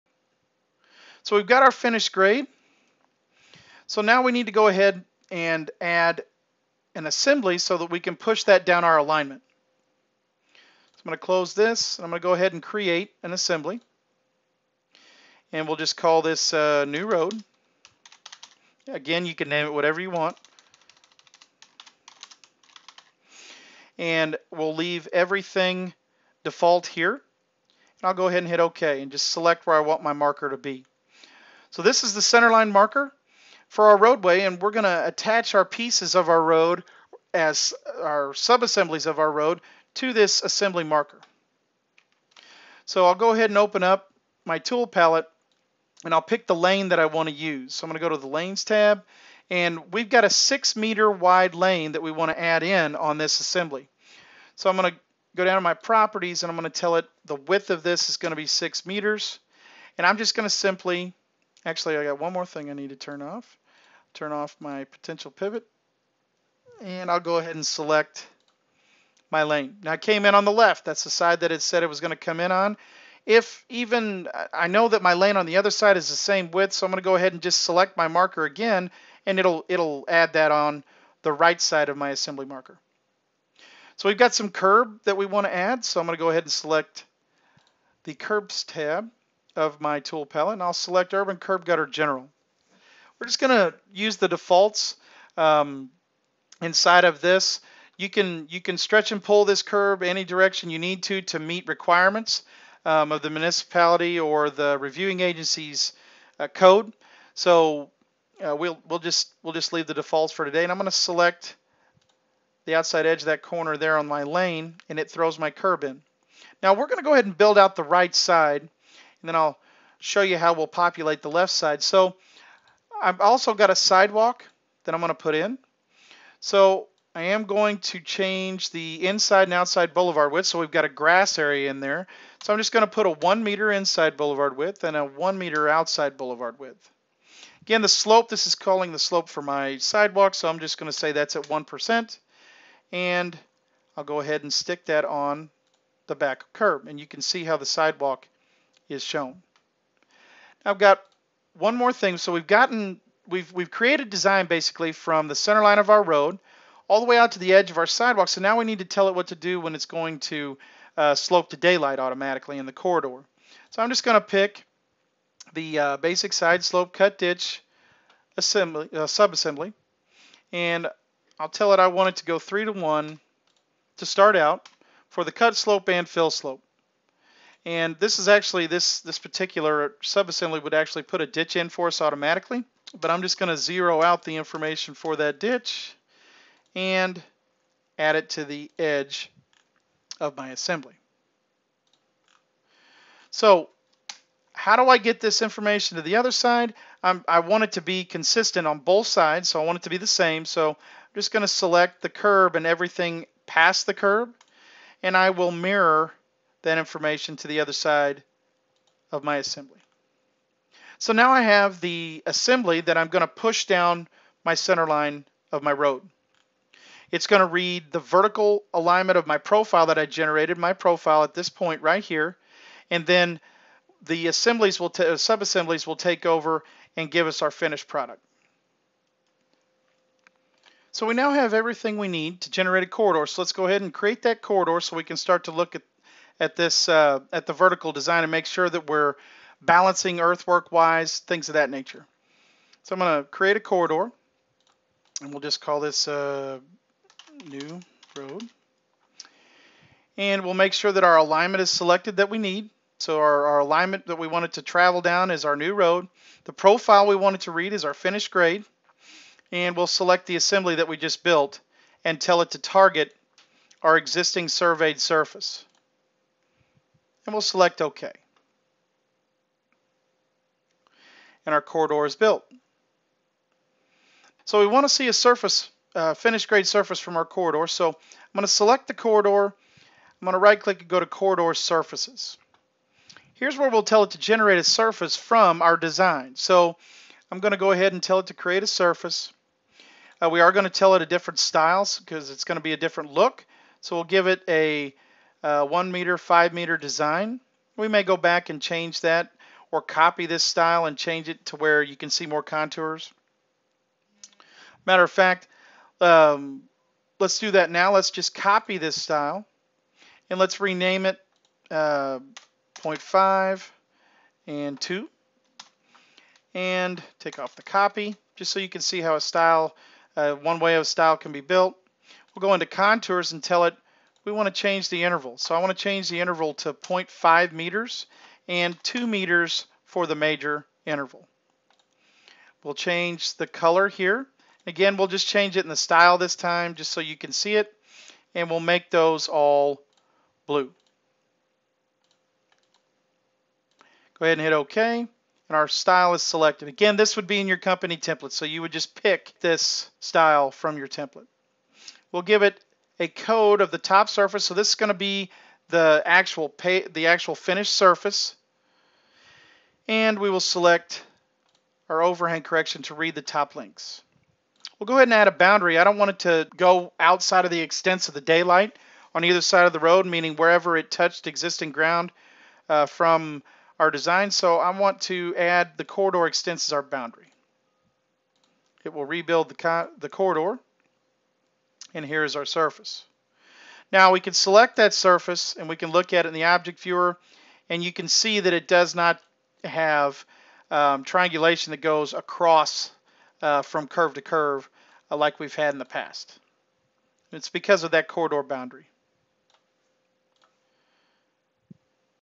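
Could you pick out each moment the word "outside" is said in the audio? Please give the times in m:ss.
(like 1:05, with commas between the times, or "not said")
1:52, 2:09, 2:15, 6:06.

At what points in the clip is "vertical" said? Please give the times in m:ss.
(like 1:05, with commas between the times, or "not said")
3:37, 3:57.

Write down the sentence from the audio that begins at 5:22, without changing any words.
We'll go into contours and tell it we want to change the interval.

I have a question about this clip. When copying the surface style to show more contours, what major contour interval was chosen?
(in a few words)
2 meters.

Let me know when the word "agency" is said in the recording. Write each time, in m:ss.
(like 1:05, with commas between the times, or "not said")
1:45.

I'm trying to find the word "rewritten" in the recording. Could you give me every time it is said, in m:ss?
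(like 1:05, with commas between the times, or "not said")
not said.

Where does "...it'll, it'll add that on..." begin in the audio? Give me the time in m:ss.
1:19.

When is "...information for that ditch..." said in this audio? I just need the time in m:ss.
3:04.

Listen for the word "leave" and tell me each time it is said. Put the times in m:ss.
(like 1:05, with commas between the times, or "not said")
0:24, 1:49.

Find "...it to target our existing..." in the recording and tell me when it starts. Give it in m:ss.
4:22.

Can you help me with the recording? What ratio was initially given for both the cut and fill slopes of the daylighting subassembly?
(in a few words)
3 to 1.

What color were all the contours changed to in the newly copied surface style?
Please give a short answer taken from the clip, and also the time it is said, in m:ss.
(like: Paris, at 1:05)
blue, at 5:40.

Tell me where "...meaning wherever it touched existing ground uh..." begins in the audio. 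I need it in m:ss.
6:10.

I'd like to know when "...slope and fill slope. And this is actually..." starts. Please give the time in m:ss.
2:55.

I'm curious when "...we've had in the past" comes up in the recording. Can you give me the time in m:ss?
6:35.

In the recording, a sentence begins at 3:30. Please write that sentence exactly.
So now I have the assembly that I'm going to push down my center line of my road.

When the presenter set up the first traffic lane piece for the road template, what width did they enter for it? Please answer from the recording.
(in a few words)
6 meters.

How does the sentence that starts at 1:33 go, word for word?
We're just going to use the defaults um, inside of this.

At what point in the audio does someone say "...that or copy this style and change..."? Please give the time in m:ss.
4:59.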